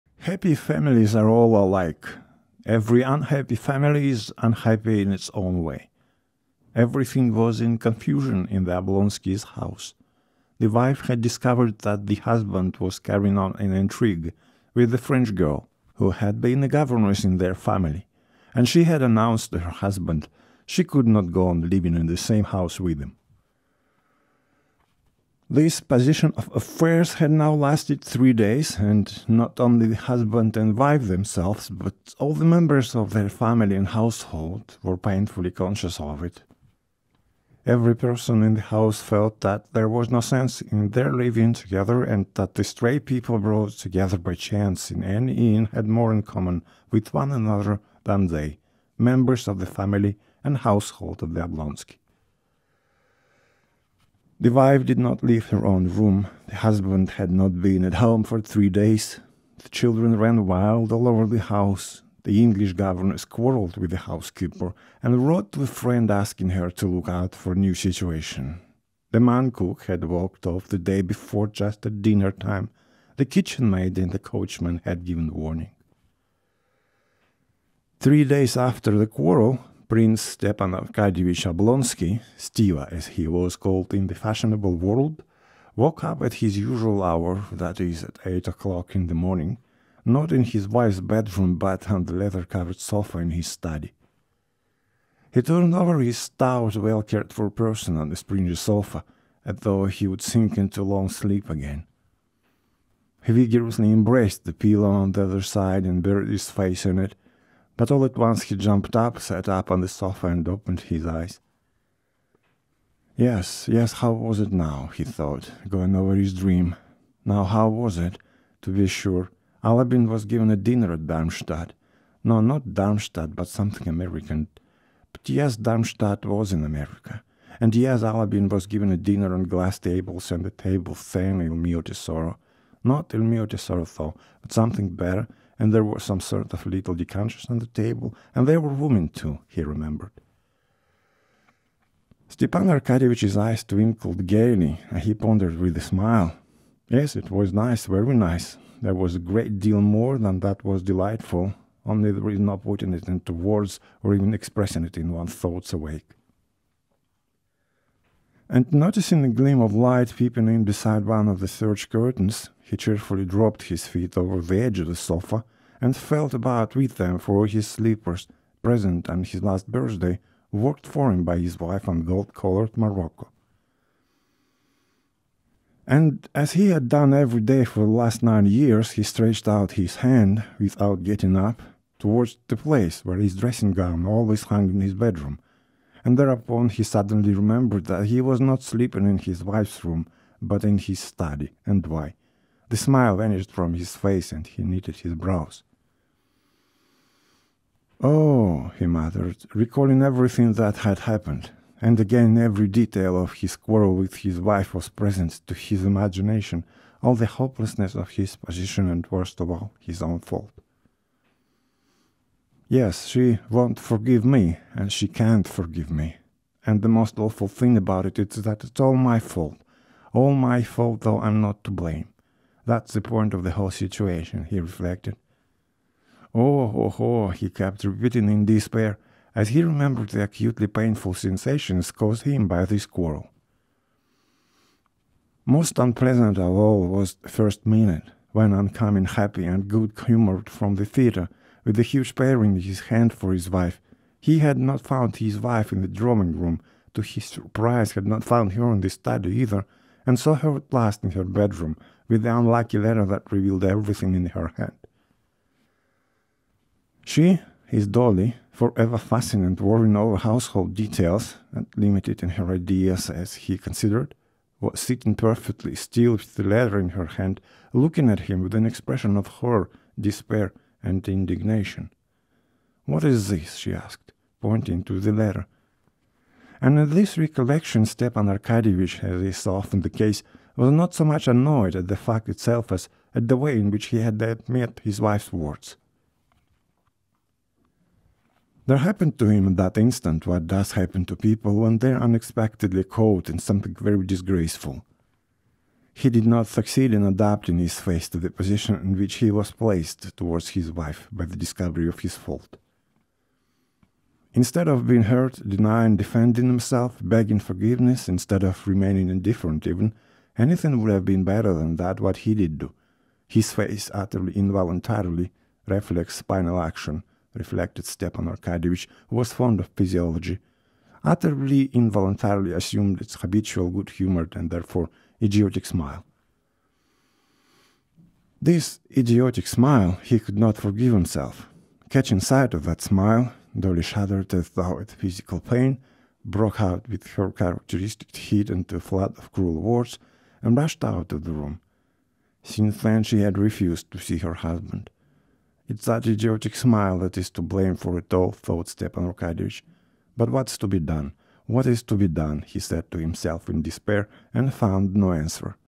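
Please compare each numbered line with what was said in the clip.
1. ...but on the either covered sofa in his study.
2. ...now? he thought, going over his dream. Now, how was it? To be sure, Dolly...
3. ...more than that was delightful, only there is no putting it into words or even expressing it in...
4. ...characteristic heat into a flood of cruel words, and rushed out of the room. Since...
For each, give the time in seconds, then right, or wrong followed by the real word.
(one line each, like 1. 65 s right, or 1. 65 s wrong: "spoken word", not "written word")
1. 91 s wrong: "leather", not "either"
2. 114 s wrong: "Alabin", not "Dolly"
3. 149 s right
4. 337 s right.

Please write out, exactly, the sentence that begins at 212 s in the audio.
Yes, she won't forgive me, and she can't forgive me.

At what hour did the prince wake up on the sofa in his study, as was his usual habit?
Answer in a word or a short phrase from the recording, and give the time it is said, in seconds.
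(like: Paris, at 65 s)
8 o'clock, at 88 s.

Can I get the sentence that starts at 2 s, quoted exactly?
Every unhappy family is unhappy in its own way.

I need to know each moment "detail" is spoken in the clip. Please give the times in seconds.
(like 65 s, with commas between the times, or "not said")
202 s, 260 s.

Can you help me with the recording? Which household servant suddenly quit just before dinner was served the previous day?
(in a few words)
The man cook.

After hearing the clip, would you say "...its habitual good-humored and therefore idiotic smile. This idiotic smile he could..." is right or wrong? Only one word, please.
right.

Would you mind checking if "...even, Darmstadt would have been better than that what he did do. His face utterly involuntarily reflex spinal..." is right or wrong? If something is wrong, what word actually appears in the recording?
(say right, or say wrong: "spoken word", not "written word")
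wrong: "Anything", not "Darmstadt".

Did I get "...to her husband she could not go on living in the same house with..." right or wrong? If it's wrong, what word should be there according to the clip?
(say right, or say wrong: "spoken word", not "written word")
right.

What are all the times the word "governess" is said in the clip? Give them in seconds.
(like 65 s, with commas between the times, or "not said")
16 s, 62 s.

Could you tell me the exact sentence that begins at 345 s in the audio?
It's that idiotic smile that is to blame for it all, thought Stepan Arkadyevich.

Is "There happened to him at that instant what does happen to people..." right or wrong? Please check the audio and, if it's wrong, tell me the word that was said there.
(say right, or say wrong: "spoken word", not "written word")
right.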